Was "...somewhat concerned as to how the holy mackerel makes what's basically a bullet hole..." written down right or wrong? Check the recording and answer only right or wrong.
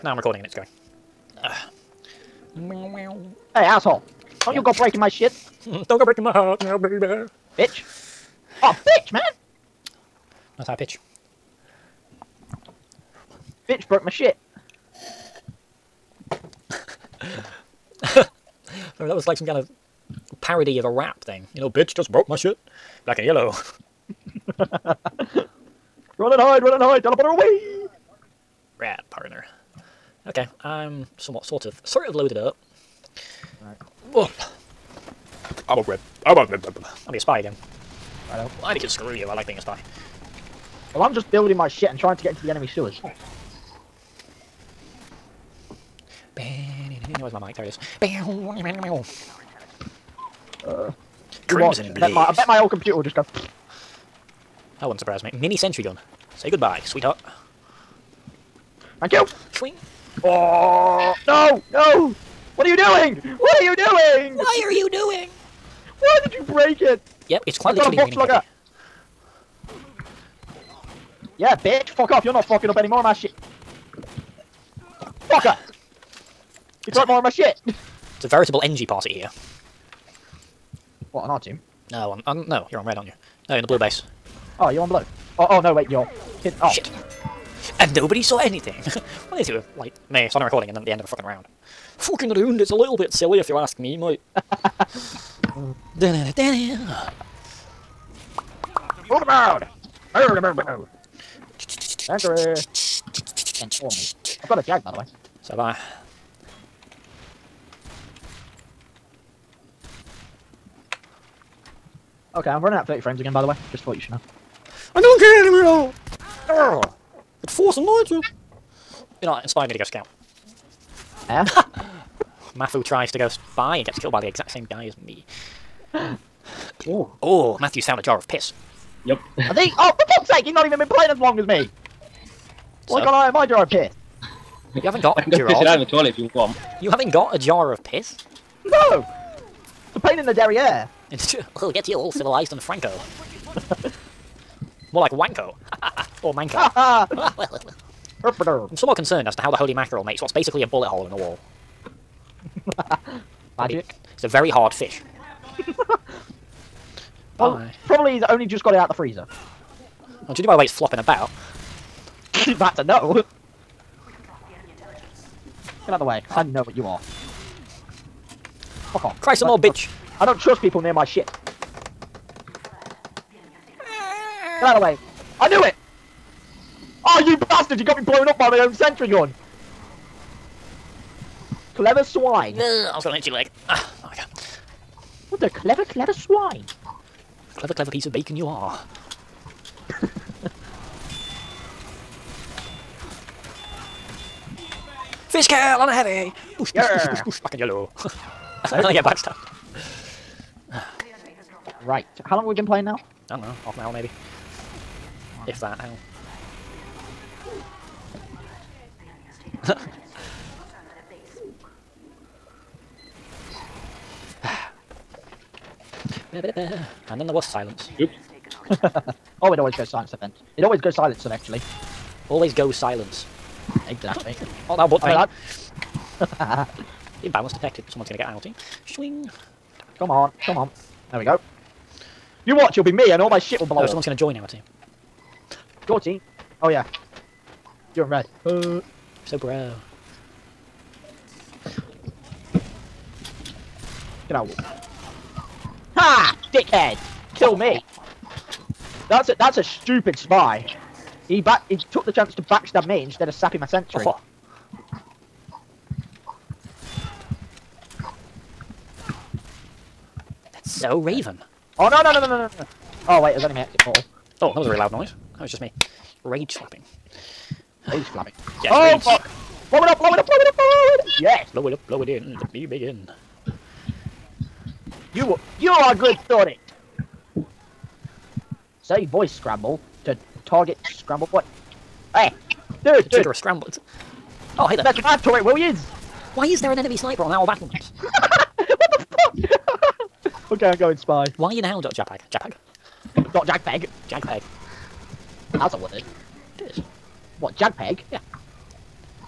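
right.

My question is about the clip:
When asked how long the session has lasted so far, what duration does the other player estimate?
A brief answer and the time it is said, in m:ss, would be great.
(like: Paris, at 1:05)
Half an hour, at 3:23.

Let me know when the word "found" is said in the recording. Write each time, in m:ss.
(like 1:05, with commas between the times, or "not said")
2:07.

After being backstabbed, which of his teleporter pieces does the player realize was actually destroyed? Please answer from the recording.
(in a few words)
Exit portal.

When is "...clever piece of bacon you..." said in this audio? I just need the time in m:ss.
3:07.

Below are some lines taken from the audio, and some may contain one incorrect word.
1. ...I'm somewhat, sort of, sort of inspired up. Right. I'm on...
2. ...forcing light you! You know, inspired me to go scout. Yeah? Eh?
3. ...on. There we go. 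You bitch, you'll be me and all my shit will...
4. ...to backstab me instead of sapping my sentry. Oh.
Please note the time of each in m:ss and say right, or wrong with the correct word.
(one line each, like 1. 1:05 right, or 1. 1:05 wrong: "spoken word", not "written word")
1. 0:30 wrong: "loaded", not "inspired"
2. 1:57 right
3. 3:50 wrong: "watch", not "bitch"
4. 4:12 right.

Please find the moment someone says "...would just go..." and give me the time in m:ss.
0:52.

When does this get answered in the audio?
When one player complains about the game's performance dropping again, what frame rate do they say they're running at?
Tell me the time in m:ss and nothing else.
1:52.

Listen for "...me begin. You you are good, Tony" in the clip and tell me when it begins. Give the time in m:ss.
4:32.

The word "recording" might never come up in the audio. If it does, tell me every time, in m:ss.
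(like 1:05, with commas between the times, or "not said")
0:00, 1:30.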